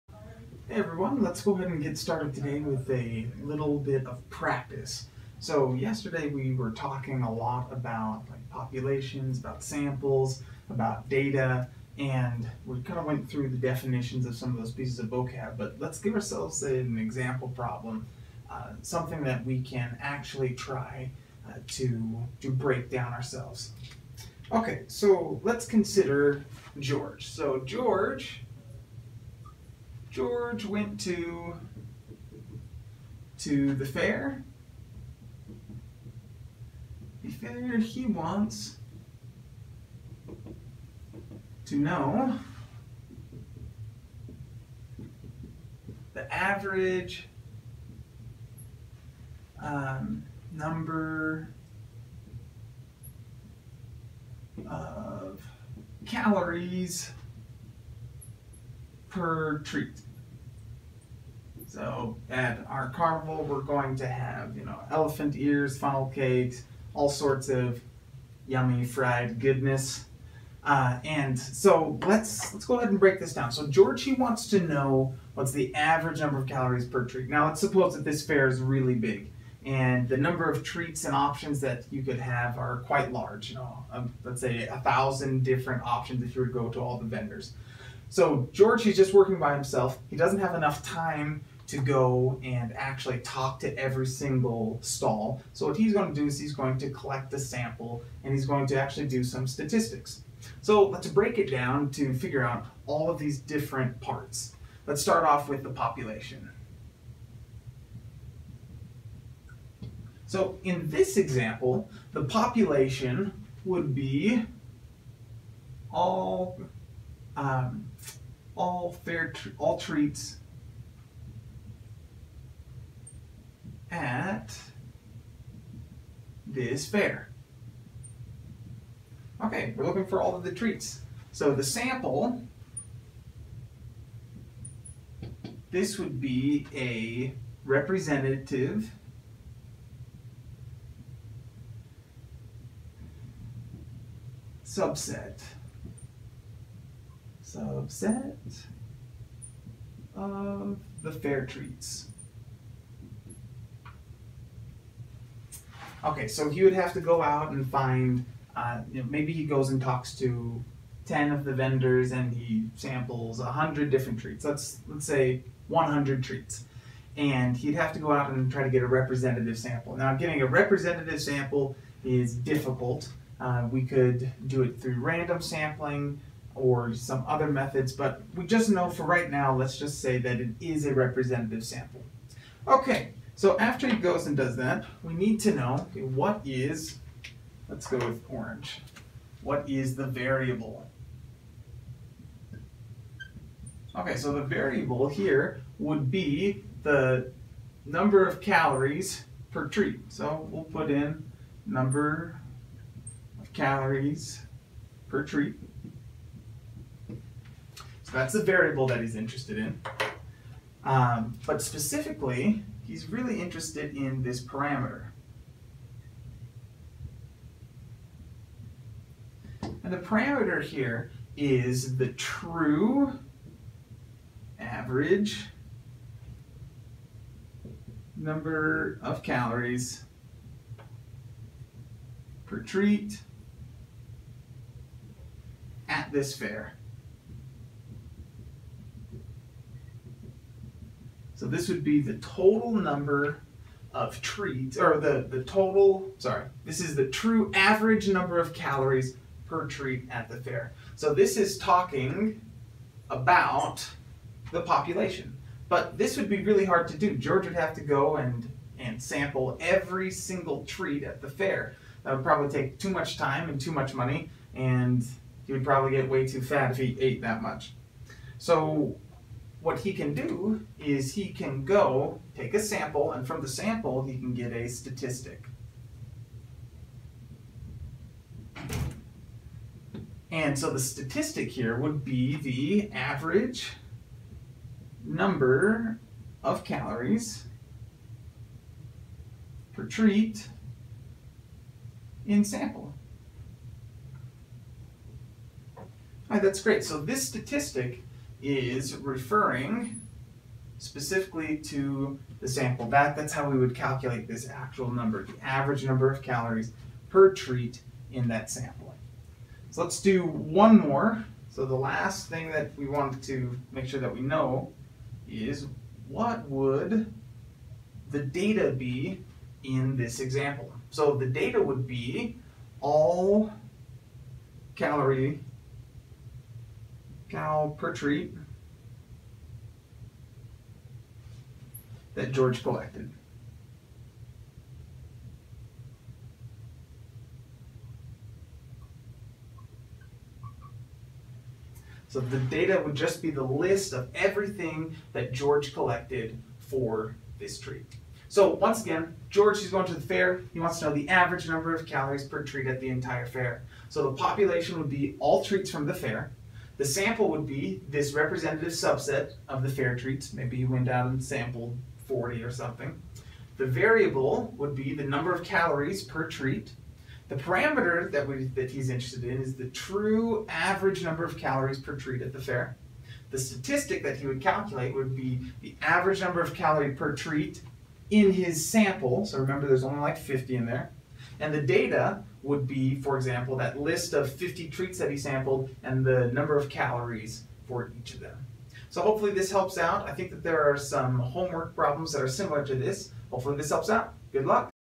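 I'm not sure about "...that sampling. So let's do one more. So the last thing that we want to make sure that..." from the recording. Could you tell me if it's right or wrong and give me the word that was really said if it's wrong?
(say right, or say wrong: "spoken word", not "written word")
right.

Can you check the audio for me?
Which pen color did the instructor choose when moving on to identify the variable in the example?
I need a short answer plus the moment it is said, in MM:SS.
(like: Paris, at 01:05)
Orange, at 03:08.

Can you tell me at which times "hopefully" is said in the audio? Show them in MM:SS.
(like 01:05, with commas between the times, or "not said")
06:29, 06:33.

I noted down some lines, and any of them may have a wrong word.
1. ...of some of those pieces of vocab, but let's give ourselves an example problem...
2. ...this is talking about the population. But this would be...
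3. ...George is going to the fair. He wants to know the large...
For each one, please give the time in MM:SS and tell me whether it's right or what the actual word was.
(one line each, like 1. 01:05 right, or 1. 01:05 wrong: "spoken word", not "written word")
1. 00:14 right
2. 04:11 right
3. 05:49 wrong: "average", not "large".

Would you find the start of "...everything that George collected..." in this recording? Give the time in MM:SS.
05:44.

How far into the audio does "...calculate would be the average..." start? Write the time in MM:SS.
06:14.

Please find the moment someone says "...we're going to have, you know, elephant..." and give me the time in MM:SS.
01:03.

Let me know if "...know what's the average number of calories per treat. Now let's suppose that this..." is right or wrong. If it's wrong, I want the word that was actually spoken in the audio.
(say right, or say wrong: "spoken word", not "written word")
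right.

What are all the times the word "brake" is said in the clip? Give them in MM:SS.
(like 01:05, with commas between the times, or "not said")
not said.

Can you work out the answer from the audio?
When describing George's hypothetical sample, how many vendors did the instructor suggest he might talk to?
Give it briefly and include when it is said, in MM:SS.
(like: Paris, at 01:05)
10, at 02:41.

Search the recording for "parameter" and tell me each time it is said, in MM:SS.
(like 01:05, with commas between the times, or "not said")
03:34, 03:39, 06:07.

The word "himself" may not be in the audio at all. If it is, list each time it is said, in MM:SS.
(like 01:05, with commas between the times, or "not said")
01:29.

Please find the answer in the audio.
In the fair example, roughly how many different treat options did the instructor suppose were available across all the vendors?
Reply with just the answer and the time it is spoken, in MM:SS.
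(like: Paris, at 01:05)
1000, at 01:24.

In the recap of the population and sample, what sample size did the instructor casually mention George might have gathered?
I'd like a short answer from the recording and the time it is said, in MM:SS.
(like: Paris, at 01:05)
40, at 06:02.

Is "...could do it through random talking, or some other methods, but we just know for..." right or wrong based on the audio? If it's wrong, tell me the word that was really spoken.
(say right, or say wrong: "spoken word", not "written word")
wrong: "sampling", not "talking".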